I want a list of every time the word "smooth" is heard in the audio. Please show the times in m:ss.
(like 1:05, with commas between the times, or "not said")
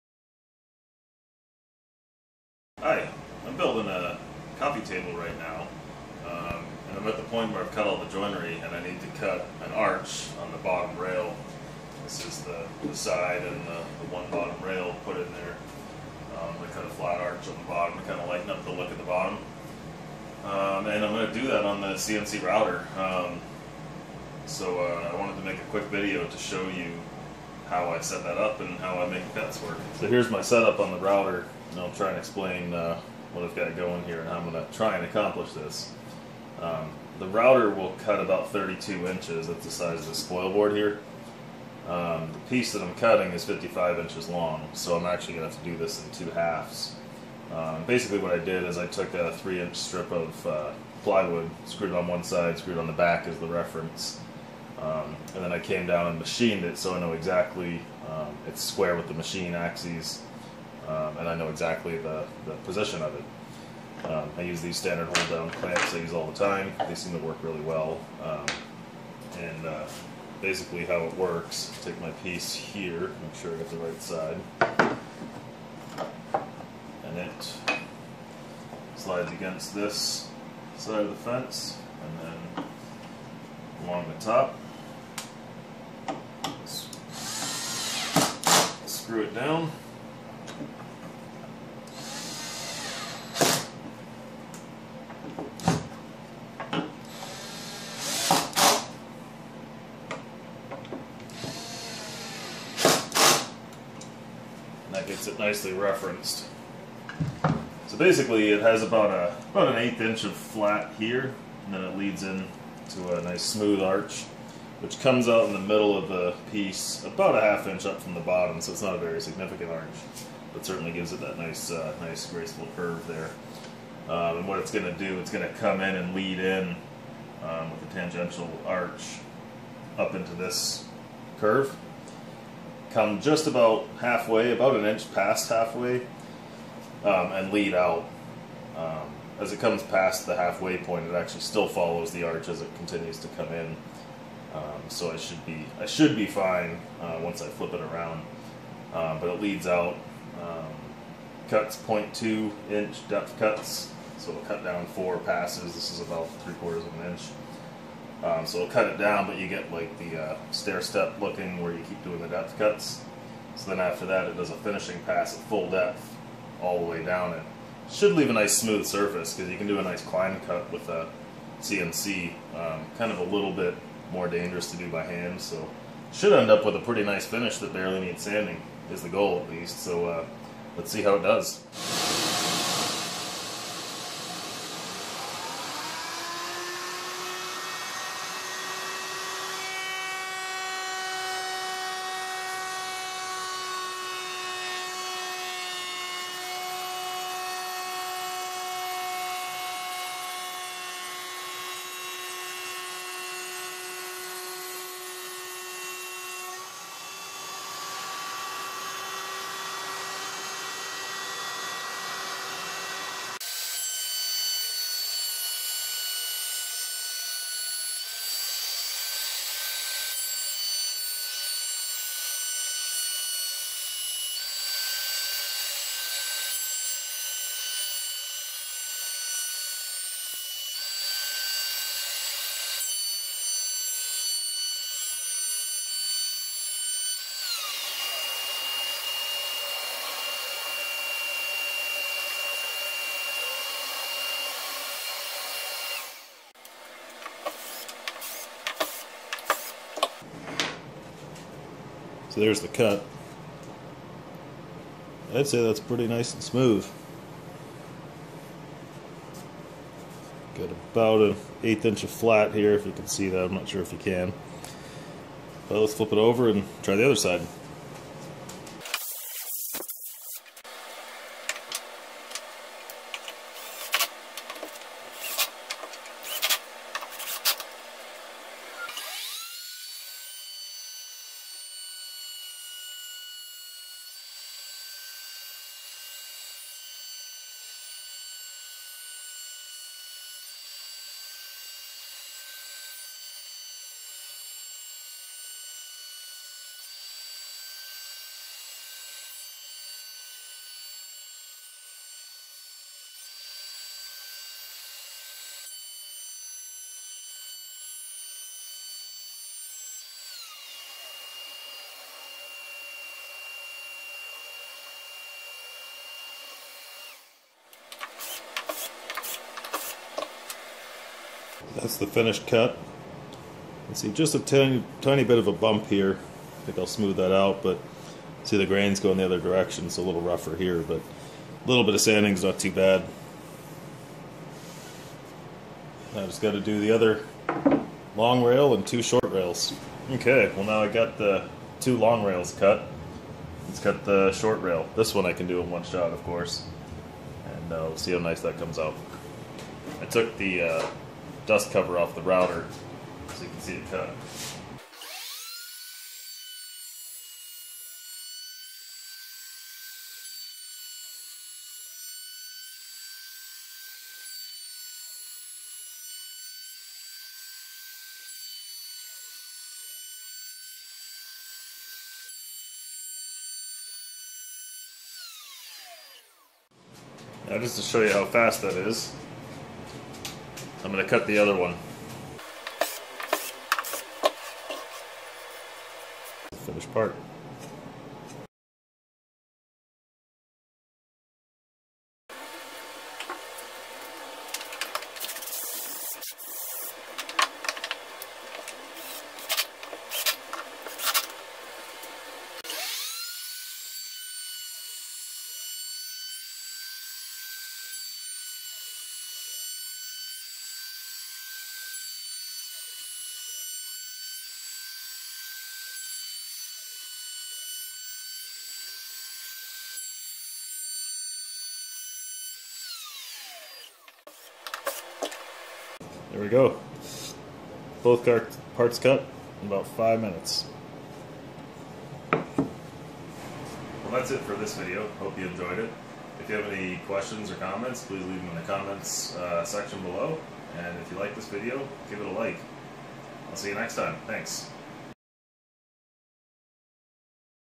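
1:53, 2:48, 4:16, 5:26.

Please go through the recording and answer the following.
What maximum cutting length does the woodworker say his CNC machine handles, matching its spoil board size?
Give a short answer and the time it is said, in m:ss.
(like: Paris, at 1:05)
32 inches, at 0:38.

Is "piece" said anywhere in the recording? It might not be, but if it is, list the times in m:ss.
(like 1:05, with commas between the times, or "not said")
0:42, 1:12, 1:56.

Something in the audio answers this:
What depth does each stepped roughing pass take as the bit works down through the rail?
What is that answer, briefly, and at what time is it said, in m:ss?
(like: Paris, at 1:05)
0.2 inch, at 2:31.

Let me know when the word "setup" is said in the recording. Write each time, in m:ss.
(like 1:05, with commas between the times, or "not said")
0:30.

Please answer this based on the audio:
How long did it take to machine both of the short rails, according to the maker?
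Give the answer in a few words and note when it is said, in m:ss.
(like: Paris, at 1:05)
5 minutes, at 7:09.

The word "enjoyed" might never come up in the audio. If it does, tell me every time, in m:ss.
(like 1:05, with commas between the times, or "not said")
7:15.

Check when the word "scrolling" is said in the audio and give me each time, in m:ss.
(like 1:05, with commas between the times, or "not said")
not said.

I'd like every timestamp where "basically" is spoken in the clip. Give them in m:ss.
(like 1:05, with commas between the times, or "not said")
0:47, 1:10, 1:47.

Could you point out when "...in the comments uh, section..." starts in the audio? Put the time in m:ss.
7:18.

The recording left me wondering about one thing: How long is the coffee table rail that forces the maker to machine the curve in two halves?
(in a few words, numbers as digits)
55 inches.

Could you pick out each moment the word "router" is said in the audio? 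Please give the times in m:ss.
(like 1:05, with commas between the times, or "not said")
0:22, 0:30, 0:37, 5:52.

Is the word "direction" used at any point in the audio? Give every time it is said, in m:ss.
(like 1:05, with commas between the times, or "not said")
5:29.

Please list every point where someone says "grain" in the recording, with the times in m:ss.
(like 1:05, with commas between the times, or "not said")
5:28.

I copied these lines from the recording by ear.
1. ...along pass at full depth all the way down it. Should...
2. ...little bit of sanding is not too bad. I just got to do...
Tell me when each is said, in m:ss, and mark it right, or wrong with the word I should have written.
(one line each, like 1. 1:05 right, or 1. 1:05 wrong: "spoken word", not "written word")
1. 2:44 wrong: "finishing", not "along"
2. 5:31 right.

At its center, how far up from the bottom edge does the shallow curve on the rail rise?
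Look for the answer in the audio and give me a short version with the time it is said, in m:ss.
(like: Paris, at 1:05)
half inch, at 1:57.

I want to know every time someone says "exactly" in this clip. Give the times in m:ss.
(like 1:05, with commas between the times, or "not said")
0:57, 1:01.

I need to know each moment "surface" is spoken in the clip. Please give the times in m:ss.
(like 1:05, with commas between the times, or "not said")
2:48.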